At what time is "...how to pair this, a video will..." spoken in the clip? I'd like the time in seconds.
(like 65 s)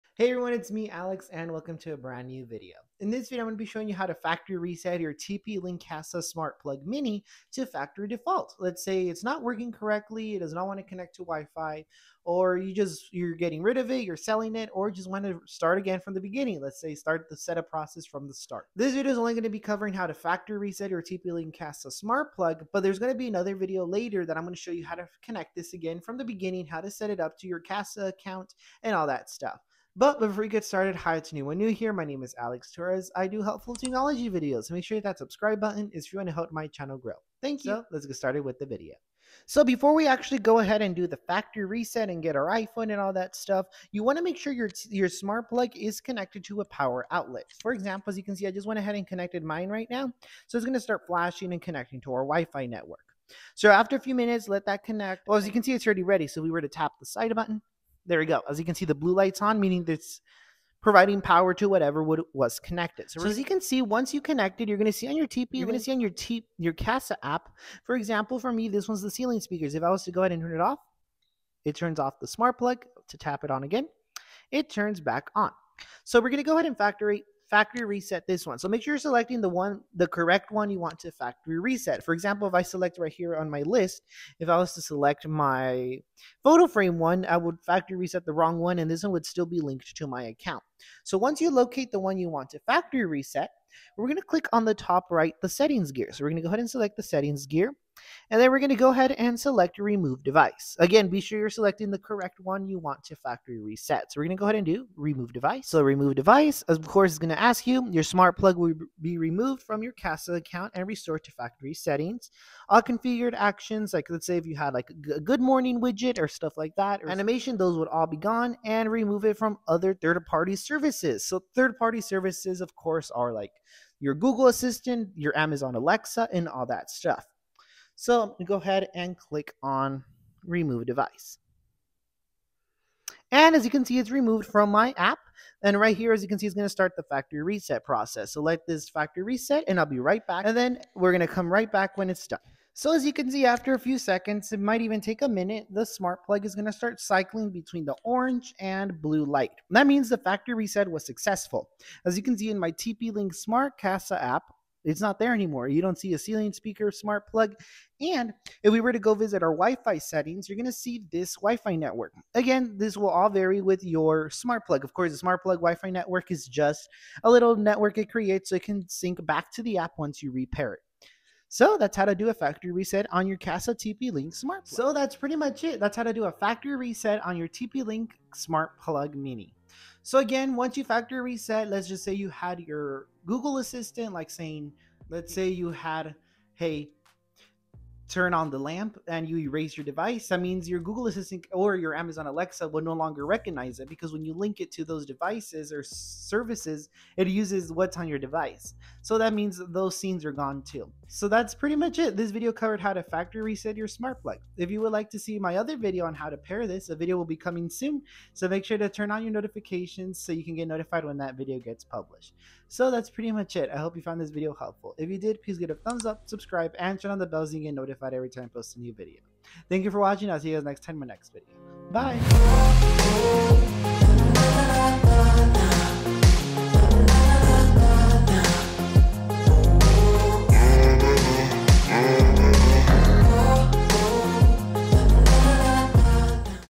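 206 s.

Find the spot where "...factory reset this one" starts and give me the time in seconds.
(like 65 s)
77 s.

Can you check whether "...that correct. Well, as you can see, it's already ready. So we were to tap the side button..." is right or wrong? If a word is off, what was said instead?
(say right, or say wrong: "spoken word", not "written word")
wrong: "connect", not "correct".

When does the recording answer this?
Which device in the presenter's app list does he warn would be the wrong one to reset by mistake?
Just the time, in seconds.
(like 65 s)
86 s.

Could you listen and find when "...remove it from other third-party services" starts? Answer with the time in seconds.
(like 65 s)
118 s.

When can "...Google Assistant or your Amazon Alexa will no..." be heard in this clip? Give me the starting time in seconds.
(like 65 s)
190 s.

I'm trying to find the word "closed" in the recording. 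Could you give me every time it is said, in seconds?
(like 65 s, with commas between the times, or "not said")
not said.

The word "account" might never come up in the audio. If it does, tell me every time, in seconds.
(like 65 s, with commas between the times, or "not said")
28 s, 90 s, 110 s.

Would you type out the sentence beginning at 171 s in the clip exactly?
So that's how to do a factory reset on your Kasa TP Link smart plug.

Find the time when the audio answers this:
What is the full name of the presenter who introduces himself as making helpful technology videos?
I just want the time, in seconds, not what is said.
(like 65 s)
32 s.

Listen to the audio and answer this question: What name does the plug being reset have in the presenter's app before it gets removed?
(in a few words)
ceiling speakers.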